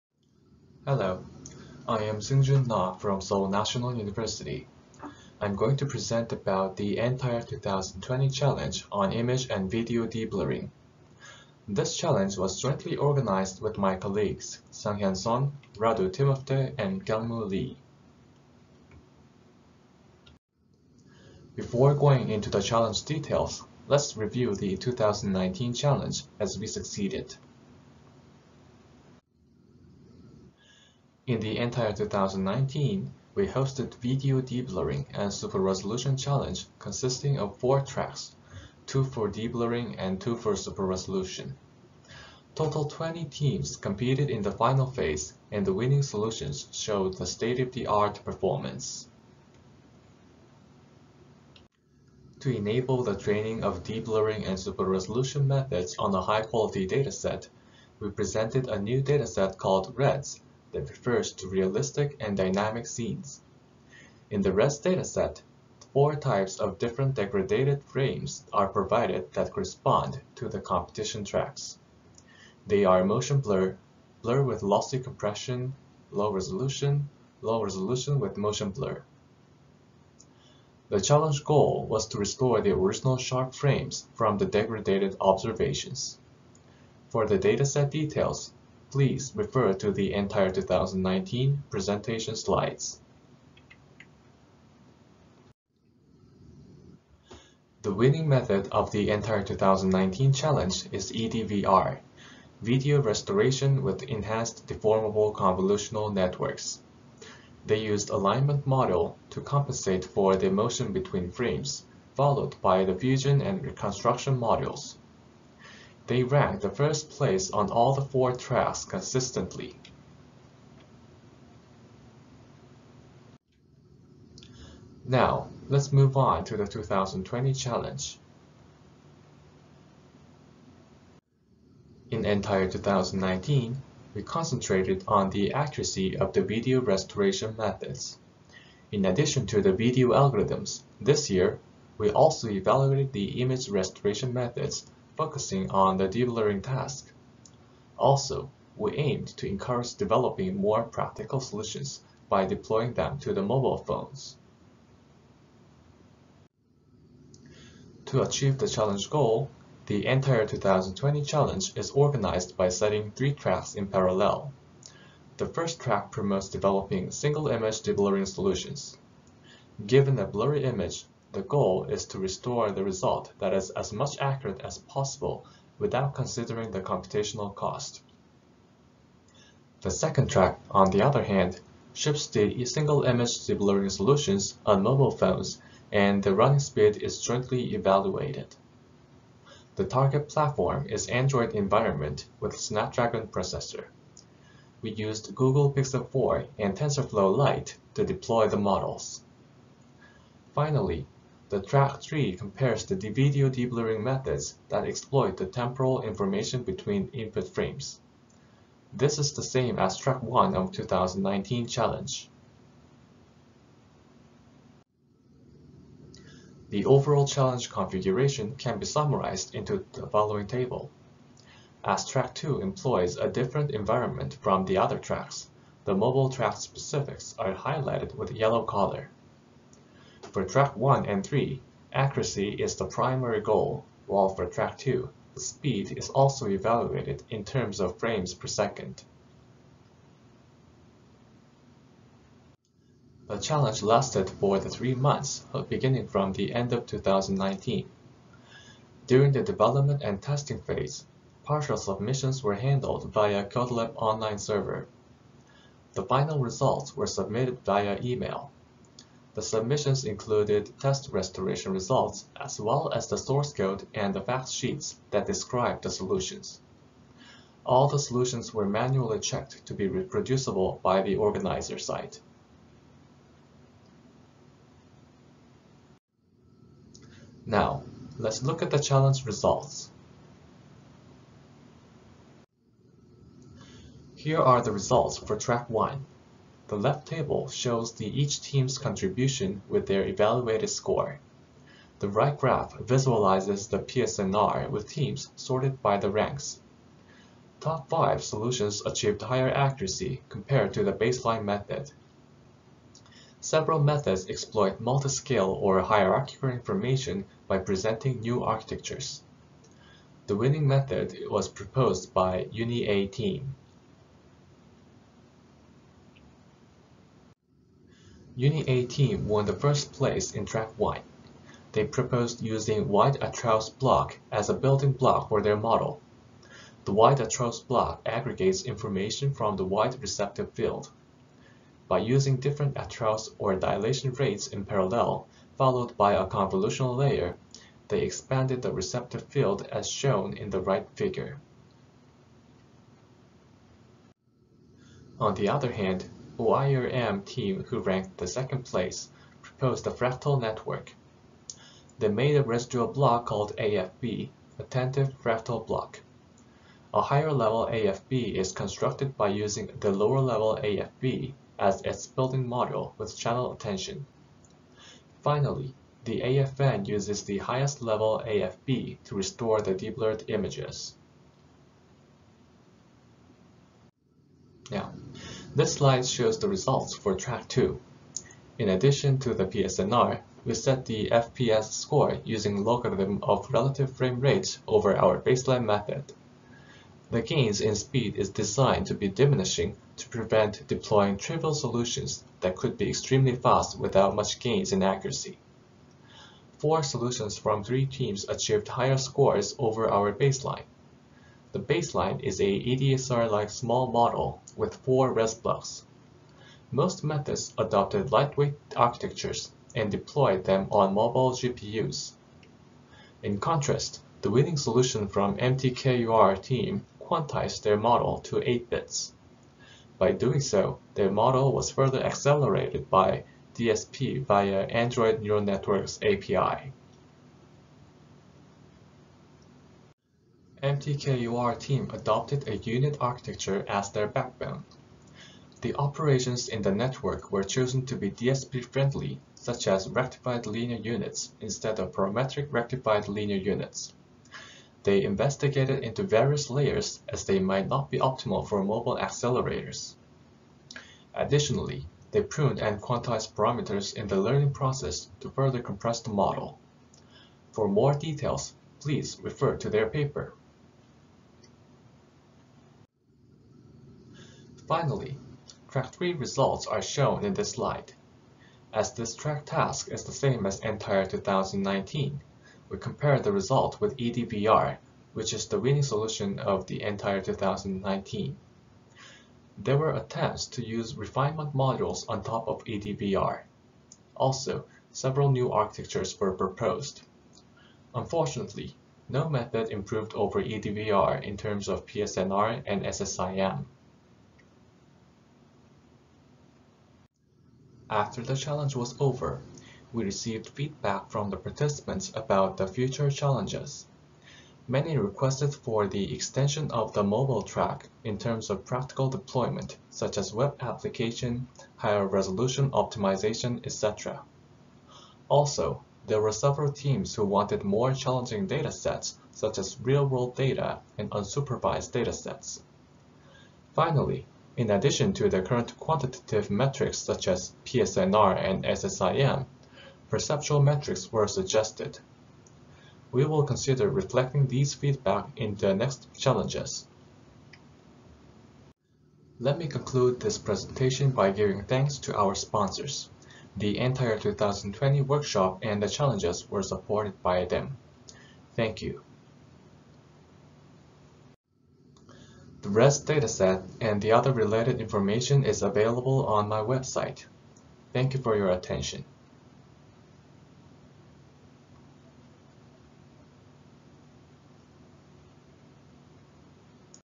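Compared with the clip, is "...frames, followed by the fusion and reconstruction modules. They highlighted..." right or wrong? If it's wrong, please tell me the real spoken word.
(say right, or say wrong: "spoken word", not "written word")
wrong: "ranked", not "highlighted".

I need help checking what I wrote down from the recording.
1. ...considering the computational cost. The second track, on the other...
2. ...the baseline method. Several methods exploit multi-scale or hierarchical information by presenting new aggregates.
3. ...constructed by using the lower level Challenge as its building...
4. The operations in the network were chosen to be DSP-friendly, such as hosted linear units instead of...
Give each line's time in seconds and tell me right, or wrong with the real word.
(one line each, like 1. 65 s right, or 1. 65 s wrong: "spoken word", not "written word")
1. 176 s right
2. 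300 s wrong: "architectures", not "aggregates"
3. 358 s wrong: "AFB", not "Challenge"
4. 435 s wrong: "rectified", not "hosted".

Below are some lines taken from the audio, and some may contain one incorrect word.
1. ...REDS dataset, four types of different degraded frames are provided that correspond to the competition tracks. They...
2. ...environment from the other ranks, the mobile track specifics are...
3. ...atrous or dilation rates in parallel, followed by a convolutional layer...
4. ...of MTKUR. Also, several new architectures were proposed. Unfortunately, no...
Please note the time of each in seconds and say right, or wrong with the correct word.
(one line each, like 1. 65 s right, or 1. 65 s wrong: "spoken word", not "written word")
1. 64 s right
2. 223 s wrong: "tracks", not "ranks"
3. 332 s right
4. 482 s wrong: "EDVR", not "MTKUR".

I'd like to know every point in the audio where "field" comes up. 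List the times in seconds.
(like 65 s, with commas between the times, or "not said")
330 s, 339 s.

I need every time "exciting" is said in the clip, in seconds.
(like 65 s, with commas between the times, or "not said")
not said.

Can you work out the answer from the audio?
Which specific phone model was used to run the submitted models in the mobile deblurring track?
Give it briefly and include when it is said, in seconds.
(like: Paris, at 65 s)
Google Pixel 4, at 195 s.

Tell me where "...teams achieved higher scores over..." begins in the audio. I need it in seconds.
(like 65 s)
397 s.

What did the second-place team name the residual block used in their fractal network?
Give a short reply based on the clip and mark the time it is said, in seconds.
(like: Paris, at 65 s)
attentive fractal block, at 354 s.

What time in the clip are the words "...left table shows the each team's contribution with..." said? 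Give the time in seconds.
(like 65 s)
286 s.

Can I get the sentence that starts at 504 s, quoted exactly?
Many requested for the extension of the mobile track in terms of practical deployment, such as web application, higher resolution optimization, etc.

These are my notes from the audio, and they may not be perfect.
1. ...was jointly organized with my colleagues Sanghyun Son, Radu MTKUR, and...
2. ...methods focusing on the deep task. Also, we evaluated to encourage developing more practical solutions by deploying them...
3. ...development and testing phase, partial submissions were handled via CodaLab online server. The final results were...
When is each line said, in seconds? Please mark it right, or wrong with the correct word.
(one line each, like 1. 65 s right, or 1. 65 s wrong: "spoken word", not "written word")
1. 12 s wrong: "Timofte", not "MTKUR"
2. 144 s wrong: "aimed", not "evaluated"
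3. 249 s right.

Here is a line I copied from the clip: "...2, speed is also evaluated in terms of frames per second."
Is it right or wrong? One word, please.
right.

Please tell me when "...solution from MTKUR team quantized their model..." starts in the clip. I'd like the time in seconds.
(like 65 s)
414 s.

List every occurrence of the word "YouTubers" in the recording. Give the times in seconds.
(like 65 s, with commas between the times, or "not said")
not said.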